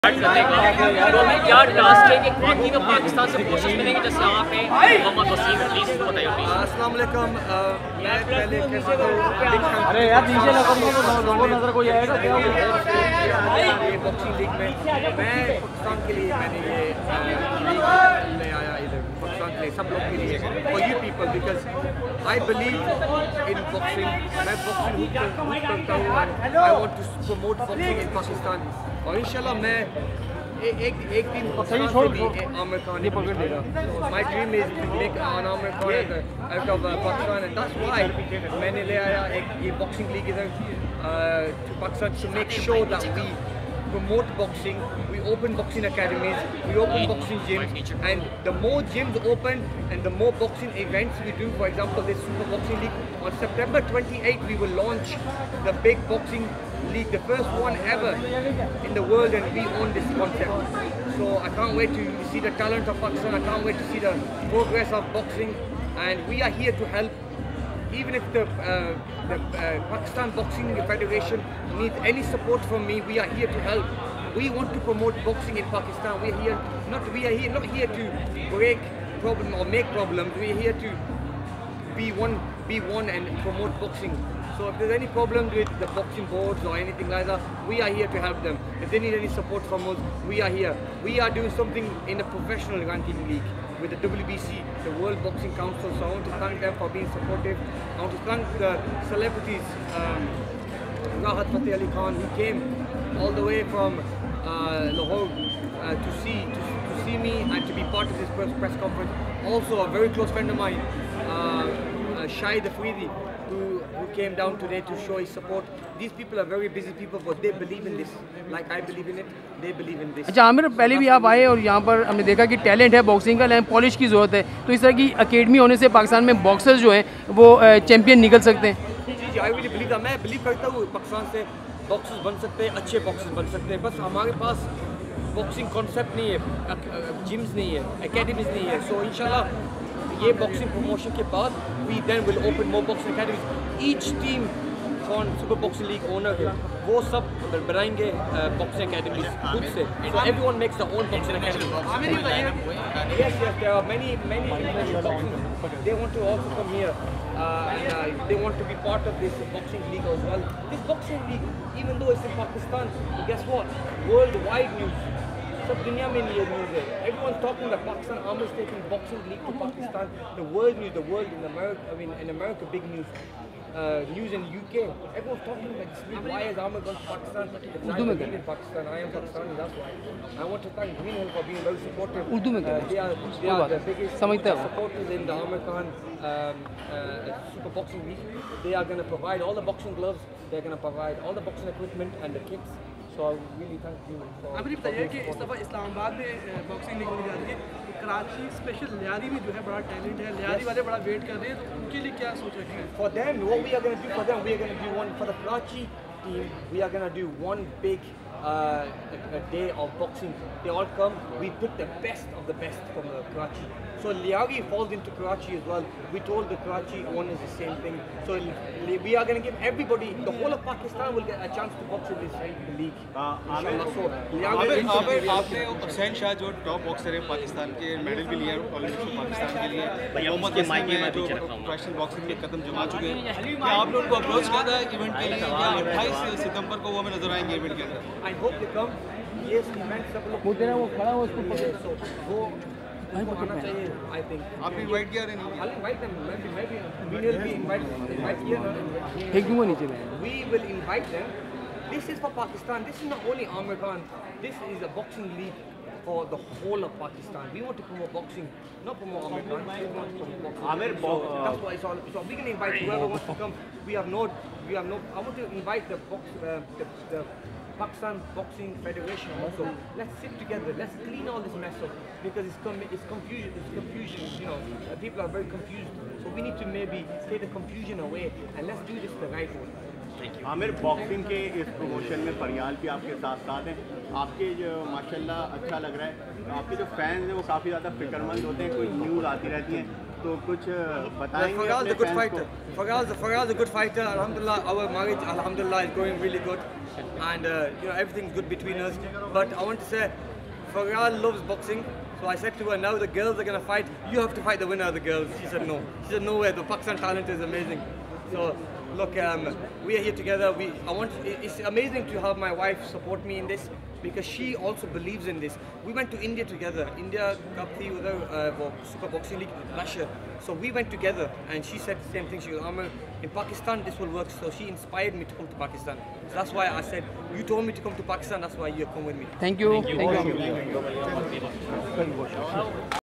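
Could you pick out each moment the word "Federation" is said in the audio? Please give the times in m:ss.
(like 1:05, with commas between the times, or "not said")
1:10, 4:28.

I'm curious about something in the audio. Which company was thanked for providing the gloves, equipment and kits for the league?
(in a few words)
Green Hill.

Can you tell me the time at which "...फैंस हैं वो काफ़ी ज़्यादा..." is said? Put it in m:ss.
4:46.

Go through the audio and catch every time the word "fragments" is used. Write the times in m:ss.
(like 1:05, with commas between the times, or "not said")
not said.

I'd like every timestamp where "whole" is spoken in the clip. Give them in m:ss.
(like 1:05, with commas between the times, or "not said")
3:40, 4:16.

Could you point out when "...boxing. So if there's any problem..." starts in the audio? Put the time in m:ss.
1:23.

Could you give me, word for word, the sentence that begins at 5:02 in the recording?
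So I said to her, now the girls are gonna fight.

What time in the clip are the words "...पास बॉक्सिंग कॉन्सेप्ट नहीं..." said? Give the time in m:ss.
2:14.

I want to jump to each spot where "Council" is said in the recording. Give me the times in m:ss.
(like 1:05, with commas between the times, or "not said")
1:35.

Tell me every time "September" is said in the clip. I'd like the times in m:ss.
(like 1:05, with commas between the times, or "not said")
0:53.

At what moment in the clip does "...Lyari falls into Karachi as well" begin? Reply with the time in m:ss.
3:34.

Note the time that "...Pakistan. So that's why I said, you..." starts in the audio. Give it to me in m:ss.
5:25.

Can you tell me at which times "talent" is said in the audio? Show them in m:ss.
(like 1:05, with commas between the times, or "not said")
1:02, 5:06.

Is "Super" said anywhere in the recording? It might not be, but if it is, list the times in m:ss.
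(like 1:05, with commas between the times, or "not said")
0:52, 3:07, 5:18.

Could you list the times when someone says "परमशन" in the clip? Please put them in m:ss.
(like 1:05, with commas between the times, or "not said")
2:20, 4:41.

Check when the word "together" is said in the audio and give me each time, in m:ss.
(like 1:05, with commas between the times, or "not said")
4:30, 5:10, 5:16, 5:20.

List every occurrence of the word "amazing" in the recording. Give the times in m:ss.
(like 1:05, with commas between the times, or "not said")
5:07, 5:11.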